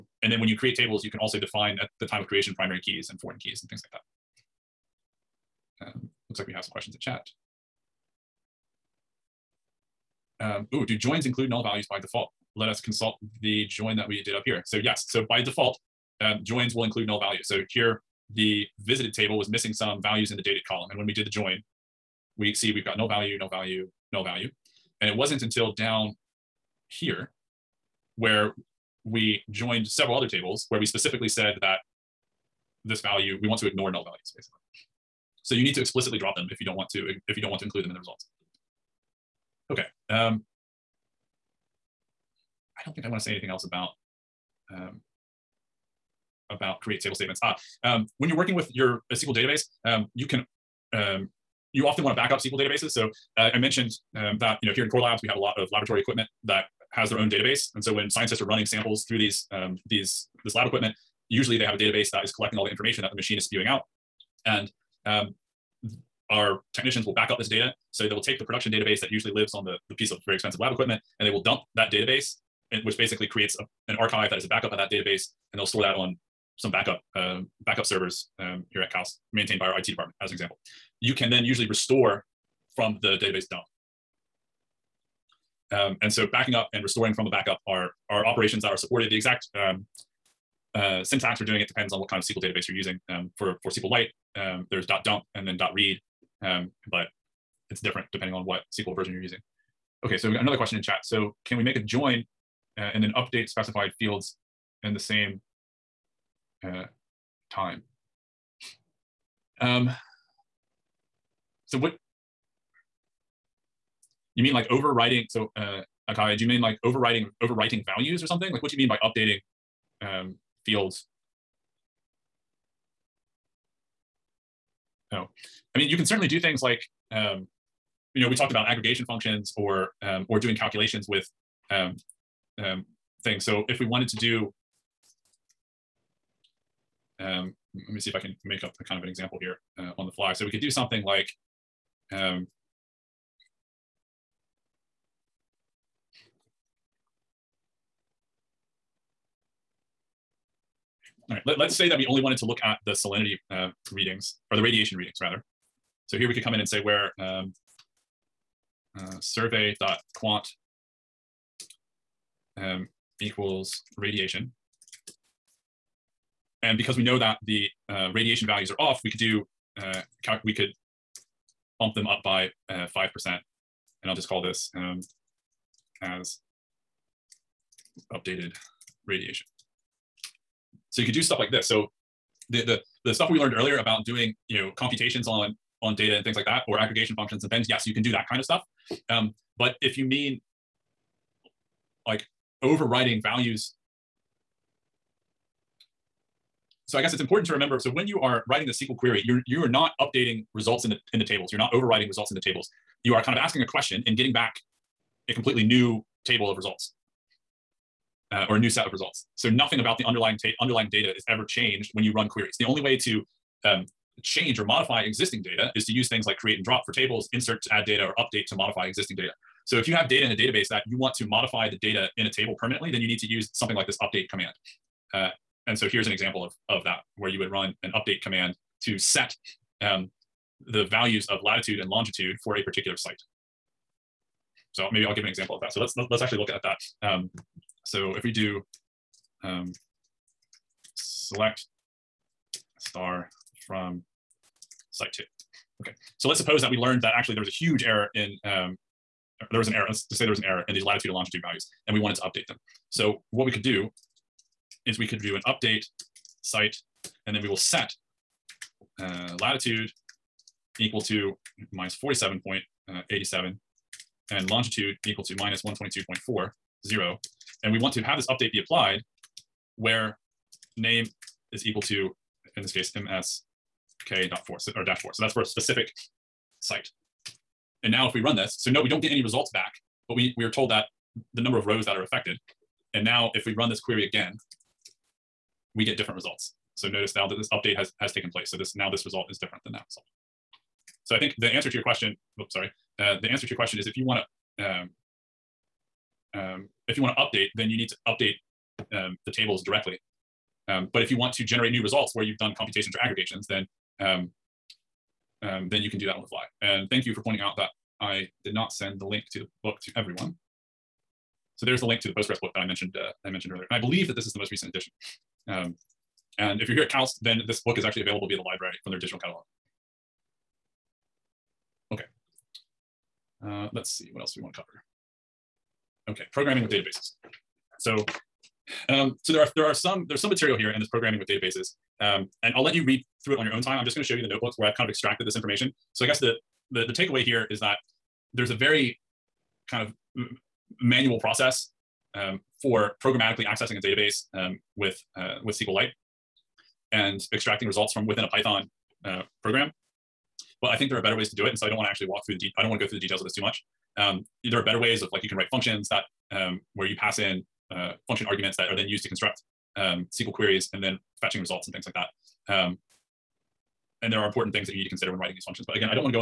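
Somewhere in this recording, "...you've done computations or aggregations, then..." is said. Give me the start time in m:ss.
5:02.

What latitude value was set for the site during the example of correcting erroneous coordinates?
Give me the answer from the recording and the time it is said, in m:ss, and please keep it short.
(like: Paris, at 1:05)
-47.87, at 4:21.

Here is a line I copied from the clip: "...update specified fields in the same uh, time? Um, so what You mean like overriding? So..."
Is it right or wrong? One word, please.
right.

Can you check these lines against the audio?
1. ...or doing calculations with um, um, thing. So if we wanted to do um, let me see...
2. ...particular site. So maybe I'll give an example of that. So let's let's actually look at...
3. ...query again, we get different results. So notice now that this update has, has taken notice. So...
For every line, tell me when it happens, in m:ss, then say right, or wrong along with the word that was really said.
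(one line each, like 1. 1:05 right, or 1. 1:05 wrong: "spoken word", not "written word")
1. 2:10 right
2. 3:52 right
3. 4:43 wrong: "place", not "notice".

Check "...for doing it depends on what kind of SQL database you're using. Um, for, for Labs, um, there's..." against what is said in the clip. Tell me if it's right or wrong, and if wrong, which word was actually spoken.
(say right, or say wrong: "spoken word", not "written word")
wrong: "SQLite", not "Labs".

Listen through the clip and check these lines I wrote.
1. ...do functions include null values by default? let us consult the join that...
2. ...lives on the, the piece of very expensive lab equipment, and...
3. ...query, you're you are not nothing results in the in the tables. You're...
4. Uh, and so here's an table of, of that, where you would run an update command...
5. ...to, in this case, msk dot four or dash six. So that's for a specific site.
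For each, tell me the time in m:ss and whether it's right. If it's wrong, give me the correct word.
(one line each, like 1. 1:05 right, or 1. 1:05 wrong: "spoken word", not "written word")
1. 0:10 wrong: "joins", not "functions"
2. 1:09 right
3. 3:18 wrong: "updating", not "nothing"
4. 3:45 wrong: "example", not "table"
5. 4:31 wrong: "four", not "six".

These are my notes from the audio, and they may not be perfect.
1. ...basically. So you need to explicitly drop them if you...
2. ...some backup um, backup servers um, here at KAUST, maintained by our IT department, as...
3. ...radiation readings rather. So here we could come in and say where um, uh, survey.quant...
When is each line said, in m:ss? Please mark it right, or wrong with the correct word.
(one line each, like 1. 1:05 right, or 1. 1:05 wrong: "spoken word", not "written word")
1. 0:34 right
2. 1:16 right
3. 2:34 right.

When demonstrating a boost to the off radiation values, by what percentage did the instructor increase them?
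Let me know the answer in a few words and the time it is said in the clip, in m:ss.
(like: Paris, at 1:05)
5%, at 2:52.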